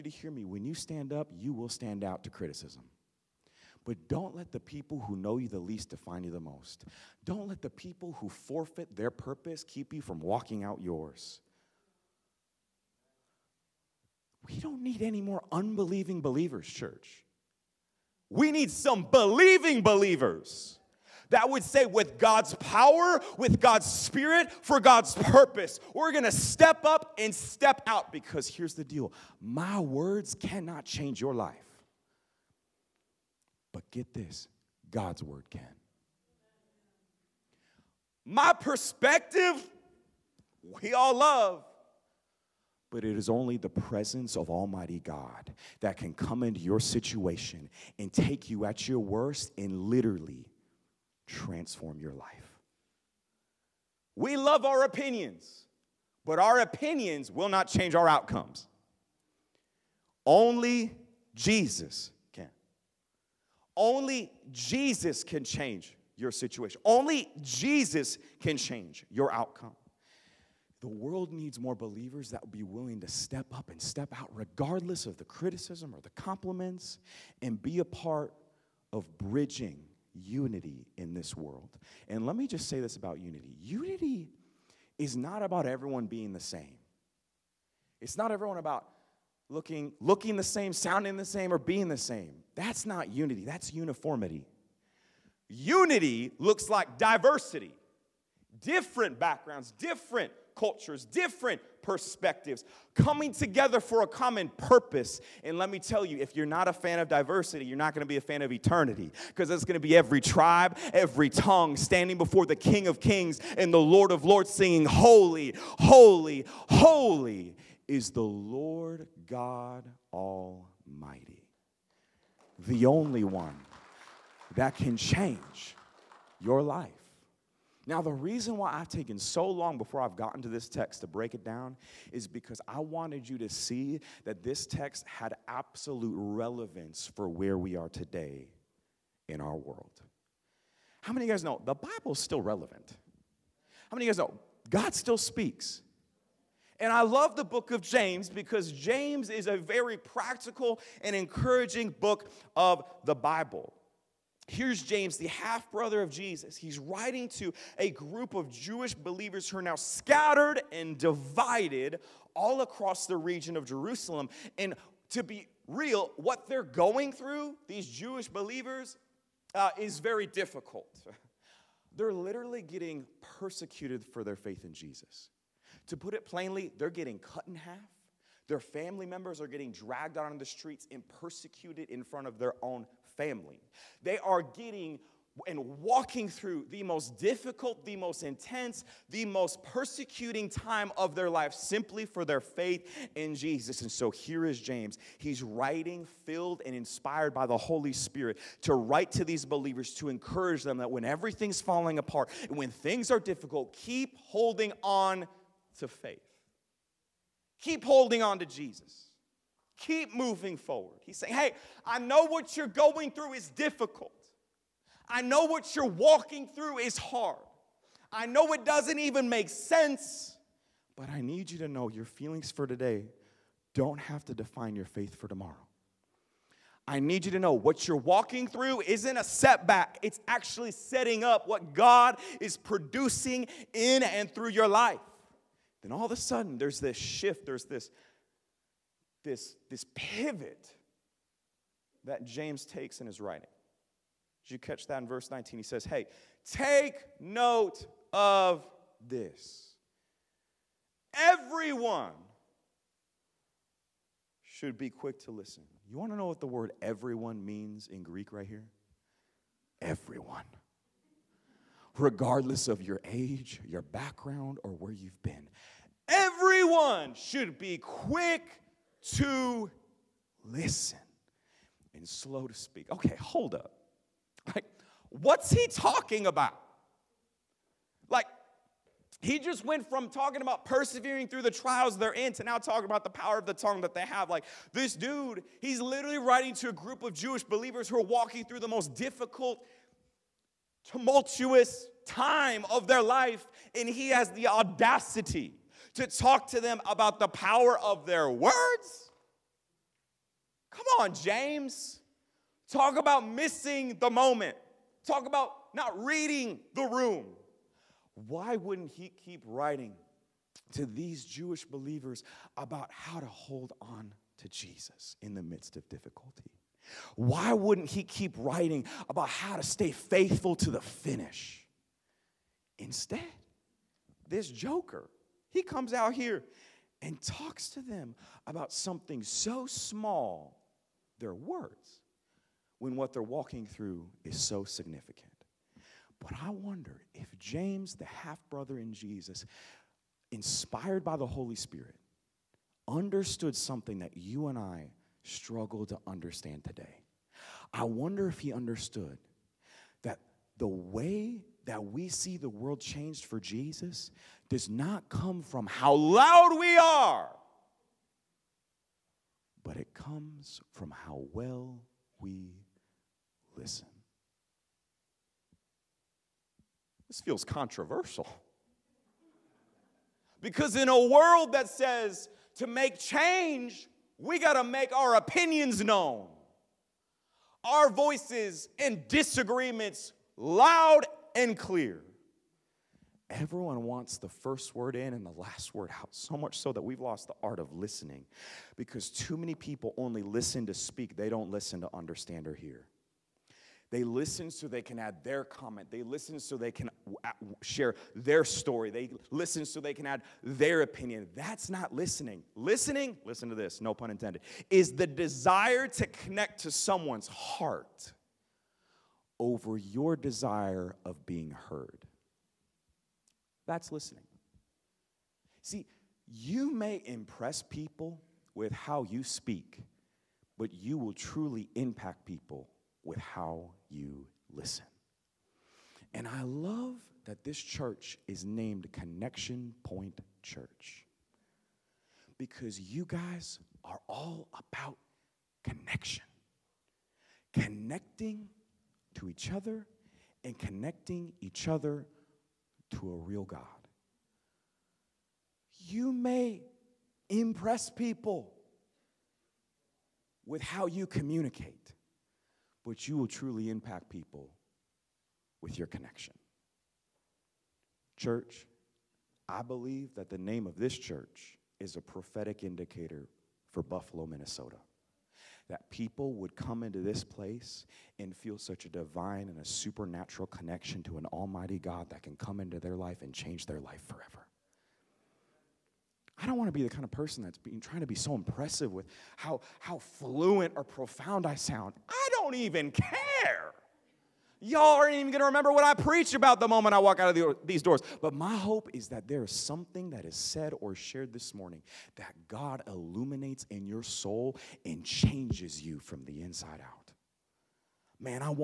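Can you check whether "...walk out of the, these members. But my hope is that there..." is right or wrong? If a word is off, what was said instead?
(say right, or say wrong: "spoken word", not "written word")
wrong: "doors", not "members".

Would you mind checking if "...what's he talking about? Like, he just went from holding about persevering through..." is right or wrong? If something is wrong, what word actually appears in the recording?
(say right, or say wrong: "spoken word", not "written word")
wrong: "talking", not "holding".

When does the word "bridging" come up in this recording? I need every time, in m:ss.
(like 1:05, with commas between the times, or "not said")
1:19.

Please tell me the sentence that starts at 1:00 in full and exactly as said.
Only Jesus only Jesus can change your situation.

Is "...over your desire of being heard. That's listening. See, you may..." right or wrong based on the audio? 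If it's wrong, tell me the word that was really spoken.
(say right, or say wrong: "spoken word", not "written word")
right.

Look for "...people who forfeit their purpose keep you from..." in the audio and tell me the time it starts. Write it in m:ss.
0:07.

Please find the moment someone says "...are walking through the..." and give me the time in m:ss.
4:47.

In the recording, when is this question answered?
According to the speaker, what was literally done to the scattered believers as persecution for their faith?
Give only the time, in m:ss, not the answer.
2:56.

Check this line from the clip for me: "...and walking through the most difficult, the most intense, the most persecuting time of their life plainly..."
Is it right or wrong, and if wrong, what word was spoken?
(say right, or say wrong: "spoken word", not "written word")
wrong: "simply", not "plainly".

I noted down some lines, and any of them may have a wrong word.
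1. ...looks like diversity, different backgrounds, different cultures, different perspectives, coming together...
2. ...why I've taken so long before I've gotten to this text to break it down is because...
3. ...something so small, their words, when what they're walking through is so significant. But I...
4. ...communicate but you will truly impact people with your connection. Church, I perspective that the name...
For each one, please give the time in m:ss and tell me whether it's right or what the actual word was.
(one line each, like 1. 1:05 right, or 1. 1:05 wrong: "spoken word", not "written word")
1. 1:36 right
2. 2:08 right
3. 5:28 right
4. 7:31 wrong: "believe", not "perspective".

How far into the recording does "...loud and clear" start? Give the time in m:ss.
6:20.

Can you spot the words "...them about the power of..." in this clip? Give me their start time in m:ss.
4:56.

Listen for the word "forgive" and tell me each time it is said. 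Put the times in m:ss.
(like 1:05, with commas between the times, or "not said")
not said.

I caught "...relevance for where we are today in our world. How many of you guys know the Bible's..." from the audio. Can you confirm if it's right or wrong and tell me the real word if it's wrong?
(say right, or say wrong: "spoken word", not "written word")
right.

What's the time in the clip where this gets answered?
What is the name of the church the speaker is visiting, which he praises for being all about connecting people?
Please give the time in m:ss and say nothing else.
7:08.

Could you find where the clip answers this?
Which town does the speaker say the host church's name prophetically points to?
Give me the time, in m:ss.
7:43.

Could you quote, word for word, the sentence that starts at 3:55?
Then all of a sudden, there's this shift, there's this, this, this pivot that James takes in his writing.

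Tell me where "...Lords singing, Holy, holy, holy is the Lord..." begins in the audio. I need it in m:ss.
1:54.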